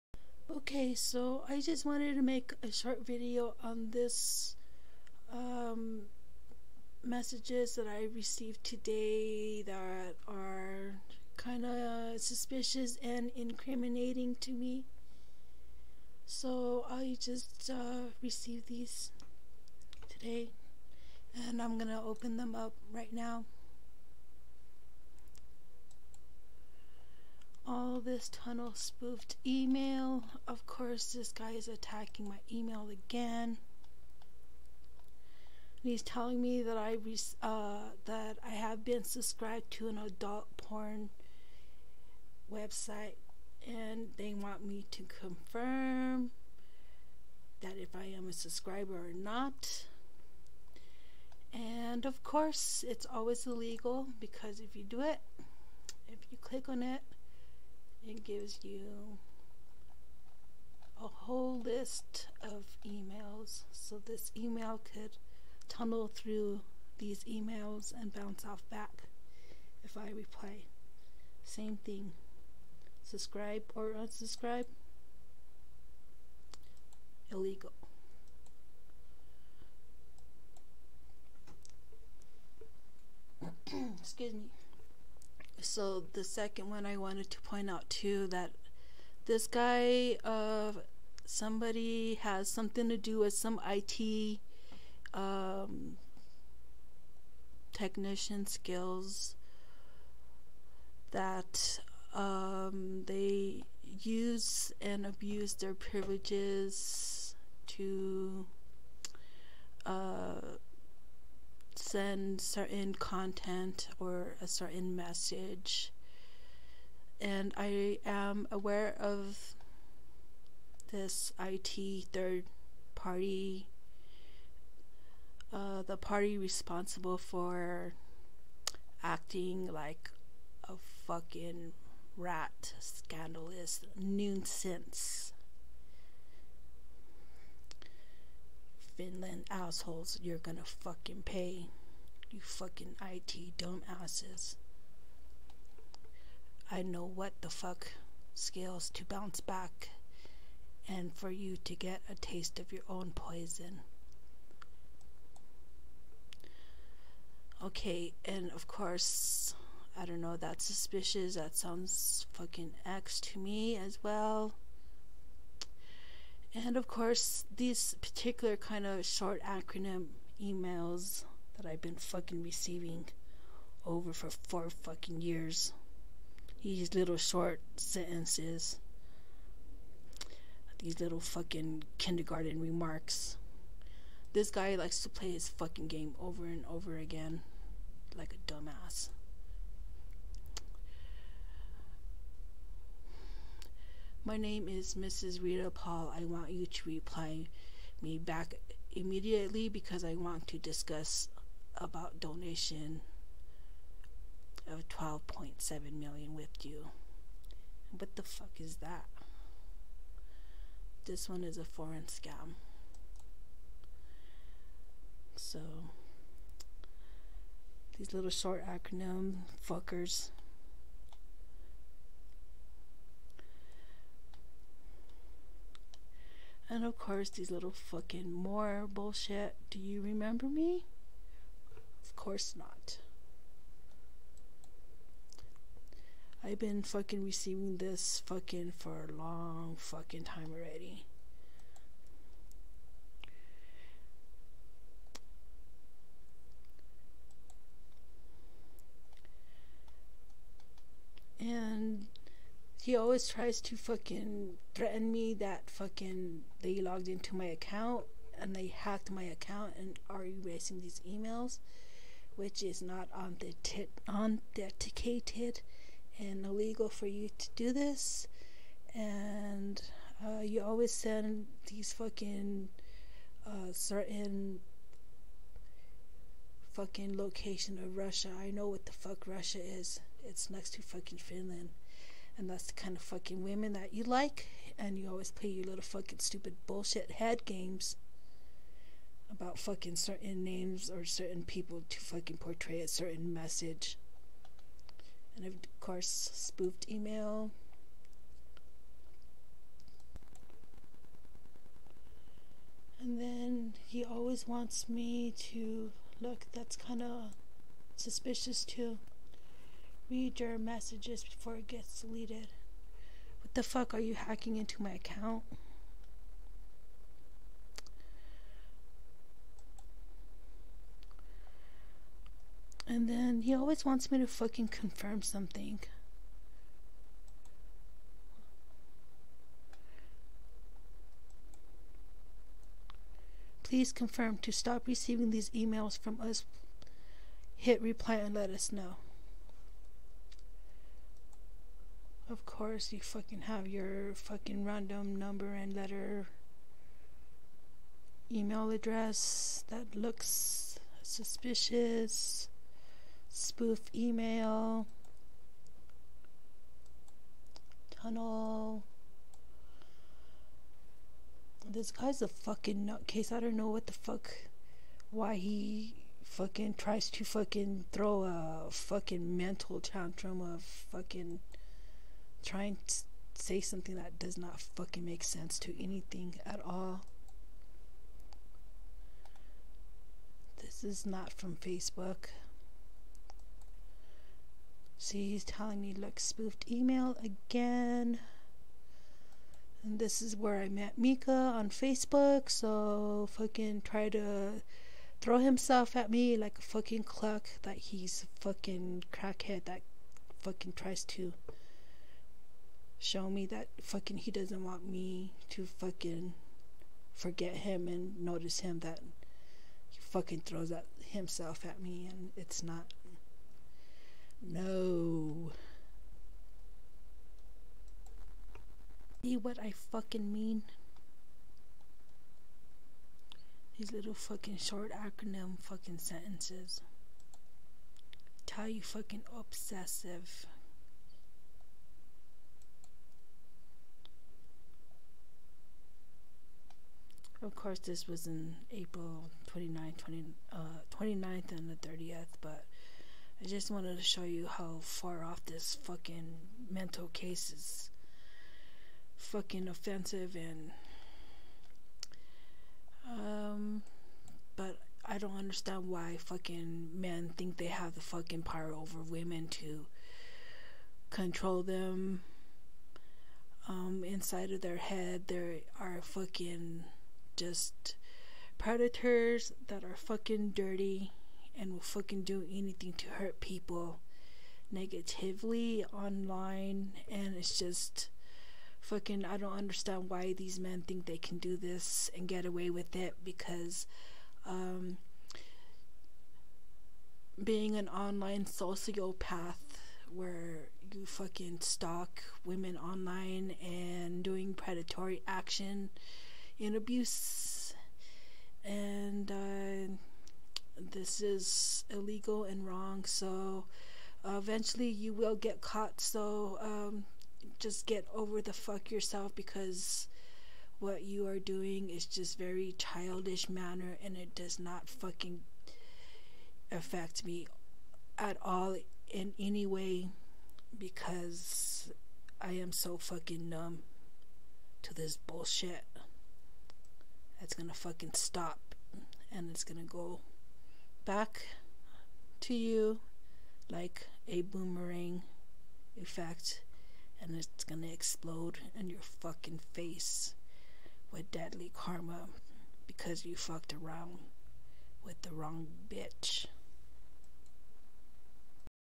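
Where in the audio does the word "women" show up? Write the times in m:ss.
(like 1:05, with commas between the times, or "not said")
4:43, 7:39, 8:12.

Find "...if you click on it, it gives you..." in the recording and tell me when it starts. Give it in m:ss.
0:56.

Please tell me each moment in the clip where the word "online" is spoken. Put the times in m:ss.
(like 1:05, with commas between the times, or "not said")
7:55, 8:07, 8:12.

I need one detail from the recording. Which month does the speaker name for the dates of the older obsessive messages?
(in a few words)
April.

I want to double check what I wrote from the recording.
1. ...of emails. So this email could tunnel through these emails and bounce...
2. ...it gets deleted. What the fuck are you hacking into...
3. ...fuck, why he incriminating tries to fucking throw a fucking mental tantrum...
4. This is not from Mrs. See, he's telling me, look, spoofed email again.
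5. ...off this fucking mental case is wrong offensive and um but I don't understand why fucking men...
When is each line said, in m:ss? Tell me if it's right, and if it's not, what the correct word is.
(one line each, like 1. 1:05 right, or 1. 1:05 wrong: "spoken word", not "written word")
1. 1:02 right
2. 5:11 right
3. 6:04 wrong: "fucking", not "incriminating"
4. 6:20 wrong: "Facebook", not "Mrs"
5. 7:25 wrong: "fucking", not "wrong".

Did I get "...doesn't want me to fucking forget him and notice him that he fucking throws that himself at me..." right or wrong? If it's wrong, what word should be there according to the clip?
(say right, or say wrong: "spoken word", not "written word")
right.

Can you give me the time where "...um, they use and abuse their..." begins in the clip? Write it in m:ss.
1:42.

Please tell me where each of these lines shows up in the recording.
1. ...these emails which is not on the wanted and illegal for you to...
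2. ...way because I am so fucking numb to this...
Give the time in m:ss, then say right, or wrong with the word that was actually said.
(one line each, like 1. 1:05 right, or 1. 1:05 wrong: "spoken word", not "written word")
1. 4:20 wrong: "authenticated", not "wanted"
2. 8:39 right.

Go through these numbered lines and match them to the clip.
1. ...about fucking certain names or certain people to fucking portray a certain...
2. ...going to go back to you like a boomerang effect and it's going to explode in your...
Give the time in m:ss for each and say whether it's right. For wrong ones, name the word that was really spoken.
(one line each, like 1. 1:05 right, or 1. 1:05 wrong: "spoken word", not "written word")
1. 4:49 right
2. 8:49 right.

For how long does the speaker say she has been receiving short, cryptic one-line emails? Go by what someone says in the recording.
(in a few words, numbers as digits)
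4 years.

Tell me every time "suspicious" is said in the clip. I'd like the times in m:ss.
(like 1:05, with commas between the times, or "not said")
0:12, 2:40, 5:07, 5:51.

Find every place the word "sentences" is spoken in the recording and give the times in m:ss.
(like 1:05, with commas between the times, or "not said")
2:57, 7:05.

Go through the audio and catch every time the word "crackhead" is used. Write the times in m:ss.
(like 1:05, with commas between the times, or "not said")
6:39.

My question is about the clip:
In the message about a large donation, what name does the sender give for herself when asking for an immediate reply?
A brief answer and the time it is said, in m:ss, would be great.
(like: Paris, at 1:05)
Mrs. Rita Paul, at 3:14.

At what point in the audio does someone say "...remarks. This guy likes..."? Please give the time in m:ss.
3:02.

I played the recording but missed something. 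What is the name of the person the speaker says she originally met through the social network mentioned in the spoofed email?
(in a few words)
Miikka.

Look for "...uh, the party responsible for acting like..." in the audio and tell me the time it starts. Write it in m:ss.
2:05.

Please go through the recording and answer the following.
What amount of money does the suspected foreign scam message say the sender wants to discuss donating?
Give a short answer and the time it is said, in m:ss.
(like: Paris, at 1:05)
12.7 million, at 3:24.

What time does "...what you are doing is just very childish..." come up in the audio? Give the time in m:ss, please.
8:30.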